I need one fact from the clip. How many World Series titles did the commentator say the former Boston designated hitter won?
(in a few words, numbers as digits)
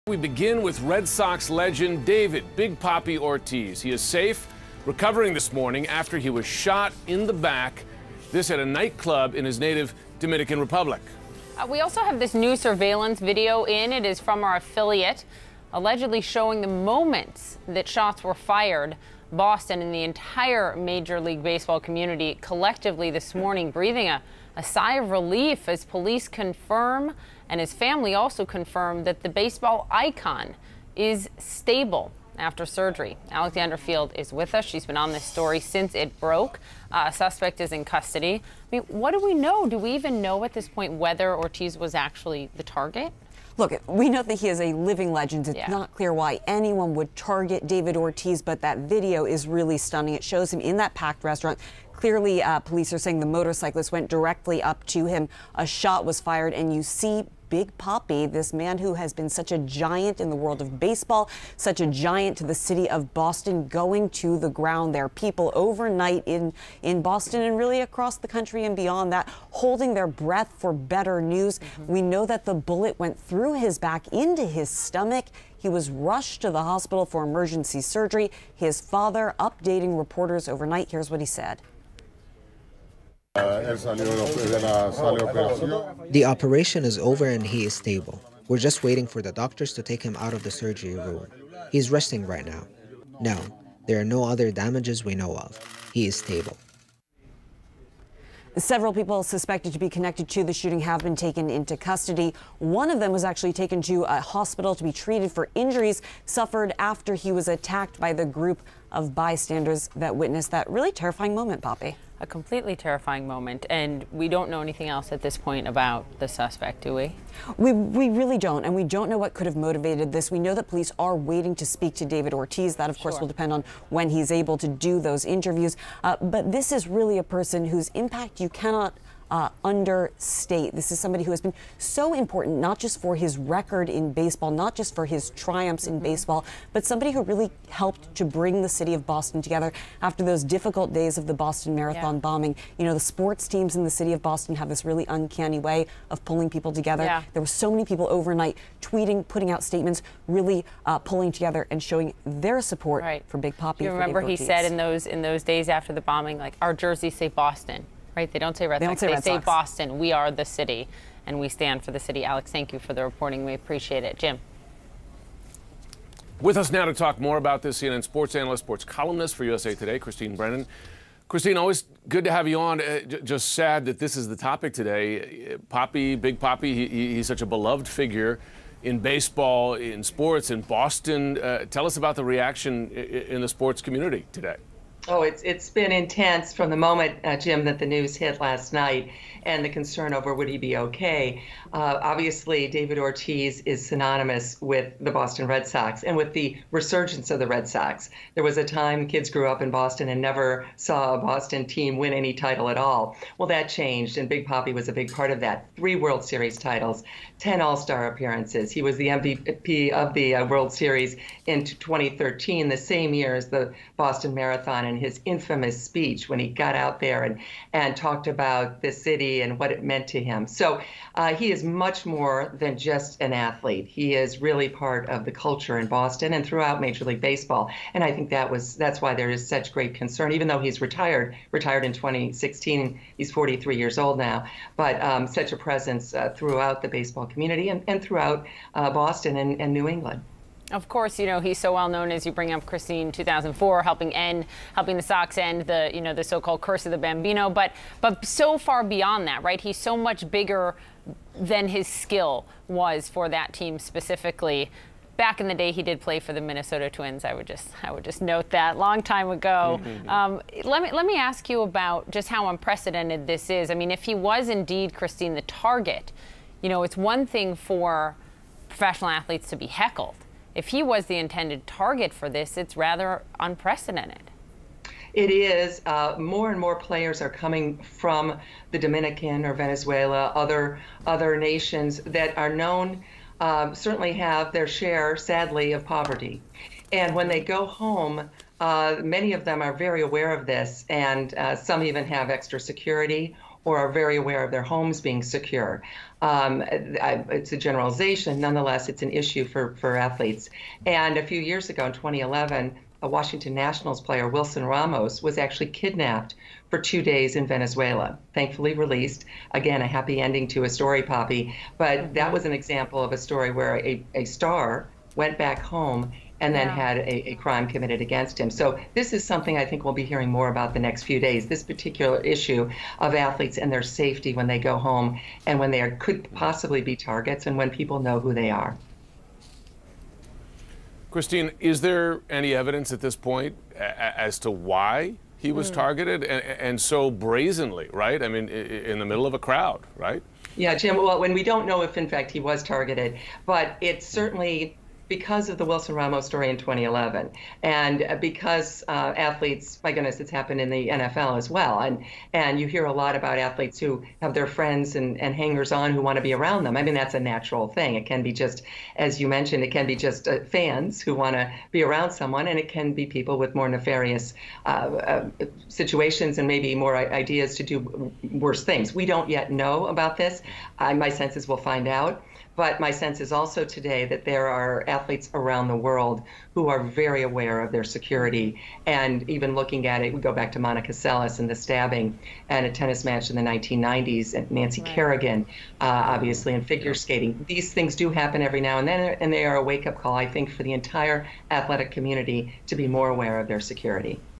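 3.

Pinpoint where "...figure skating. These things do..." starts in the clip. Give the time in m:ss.
6:26.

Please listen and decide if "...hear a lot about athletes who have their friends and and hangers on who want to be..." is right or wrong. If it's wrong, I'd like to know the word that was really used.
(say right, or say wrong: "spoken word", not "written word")
right.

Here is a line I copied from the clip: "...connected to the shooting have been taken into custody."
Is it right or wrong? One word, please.
right.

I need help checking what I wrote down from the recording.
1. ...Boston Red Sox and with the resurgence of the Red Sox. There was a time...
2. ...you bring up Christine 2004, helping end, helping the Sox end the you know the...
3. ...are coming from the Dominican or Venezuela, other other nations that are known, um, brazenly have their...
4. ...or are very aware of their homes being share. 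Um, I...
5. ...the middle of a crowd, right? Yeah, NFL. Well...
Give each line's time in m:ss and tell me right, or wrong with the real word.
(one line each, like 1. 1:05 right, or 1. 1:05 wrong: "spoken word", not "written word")
1. 3:15 right
2. 4:02 right
3. 4:37 wrong: "certainly", not "brazenly"
4. 4:53 wrong: "secure", not "share"
5. 5:38 wrong: "Jim", not "NFL".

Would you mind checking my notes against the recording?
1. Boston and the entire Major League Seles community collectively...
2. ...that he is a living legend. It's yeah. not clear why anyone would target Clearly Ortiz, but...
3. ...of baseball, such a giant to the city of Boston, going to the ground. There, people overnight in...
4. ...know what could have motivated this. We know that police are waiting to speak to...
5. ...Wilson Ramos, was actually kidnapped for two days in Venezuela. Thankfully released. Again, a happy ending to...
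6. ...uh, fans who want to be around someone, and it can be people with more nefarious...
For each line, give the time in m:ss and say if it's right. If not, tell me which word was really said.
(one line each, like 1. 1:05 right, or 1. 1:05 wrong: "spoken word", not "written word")
1. 0:19 wrong: "Baseball", not "Seles"
2. 0:44 wrong: "David", not "Clearly"
3. 1:00 right
4. 1:59 right
5. 5:04 right
6. 6:00 right.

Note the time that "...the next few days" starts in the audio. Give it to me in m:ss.
5:20.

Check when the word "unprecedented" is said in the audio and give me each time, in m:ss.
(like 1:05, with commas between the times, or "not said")
4:22, 4:33.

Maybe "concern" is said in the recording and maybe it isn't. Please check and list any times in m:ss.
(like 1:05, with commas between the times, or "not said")
3:09, 3:49.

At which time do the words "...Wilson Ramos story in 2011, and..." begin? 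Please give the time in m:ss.
5:45.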